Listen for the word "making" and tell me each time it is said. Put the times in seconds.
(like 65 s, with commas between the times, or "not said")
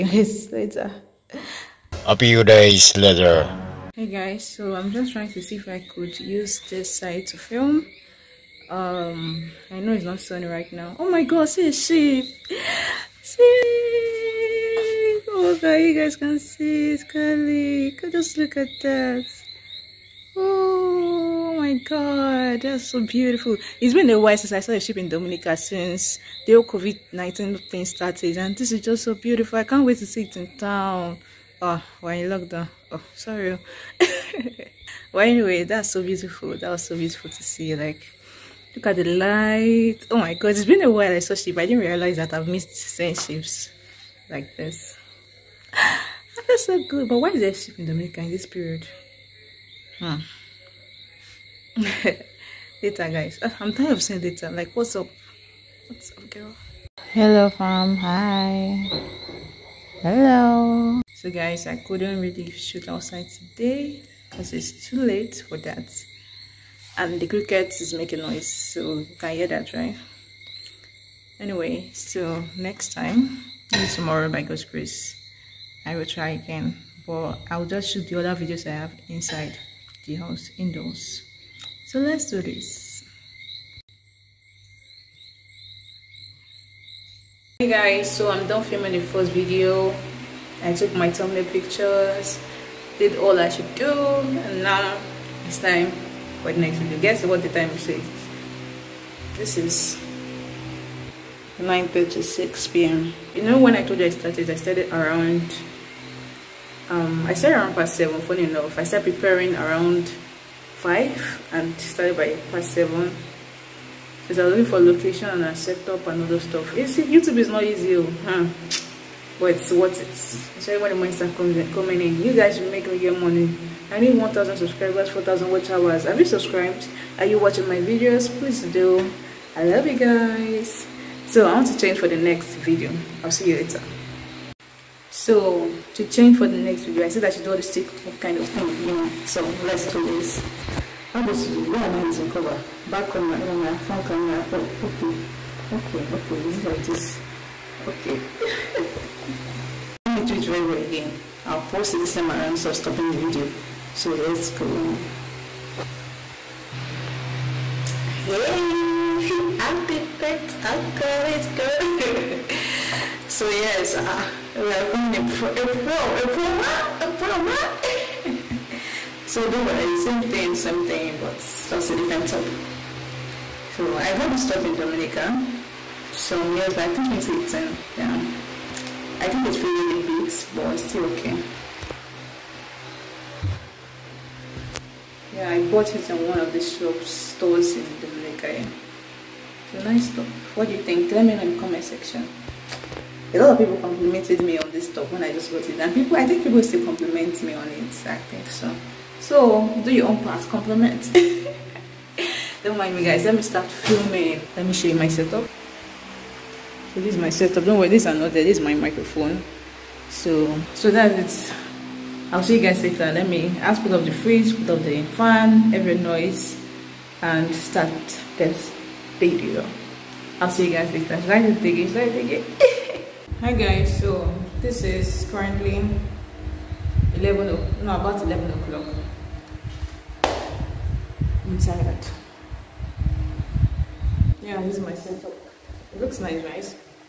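67 s.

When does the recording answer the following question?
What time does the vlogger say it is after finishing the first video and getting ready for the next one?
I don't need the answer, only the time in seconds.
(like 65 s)
101 s.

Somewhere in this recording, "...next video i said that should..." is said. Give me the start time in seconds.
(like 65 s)
136 s.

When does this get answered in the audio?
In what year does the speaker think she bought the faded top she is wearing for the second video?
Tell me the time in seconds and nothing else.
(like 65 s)
177 s.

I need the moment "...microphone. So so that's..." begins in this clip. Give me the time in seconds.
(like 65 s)
208 s.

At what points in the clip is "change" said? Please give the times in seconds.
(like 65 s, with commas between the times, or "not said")
131 s, 136 s.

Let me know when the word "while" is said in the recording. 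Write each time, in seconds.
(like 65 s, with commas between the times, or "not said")
24 s, 40 s.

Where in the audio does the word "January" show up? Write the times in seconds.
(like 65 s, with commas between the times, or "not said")
not said.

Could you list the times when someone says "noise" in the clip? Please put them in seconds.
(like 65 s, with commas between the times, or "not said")
68 s, 215 s.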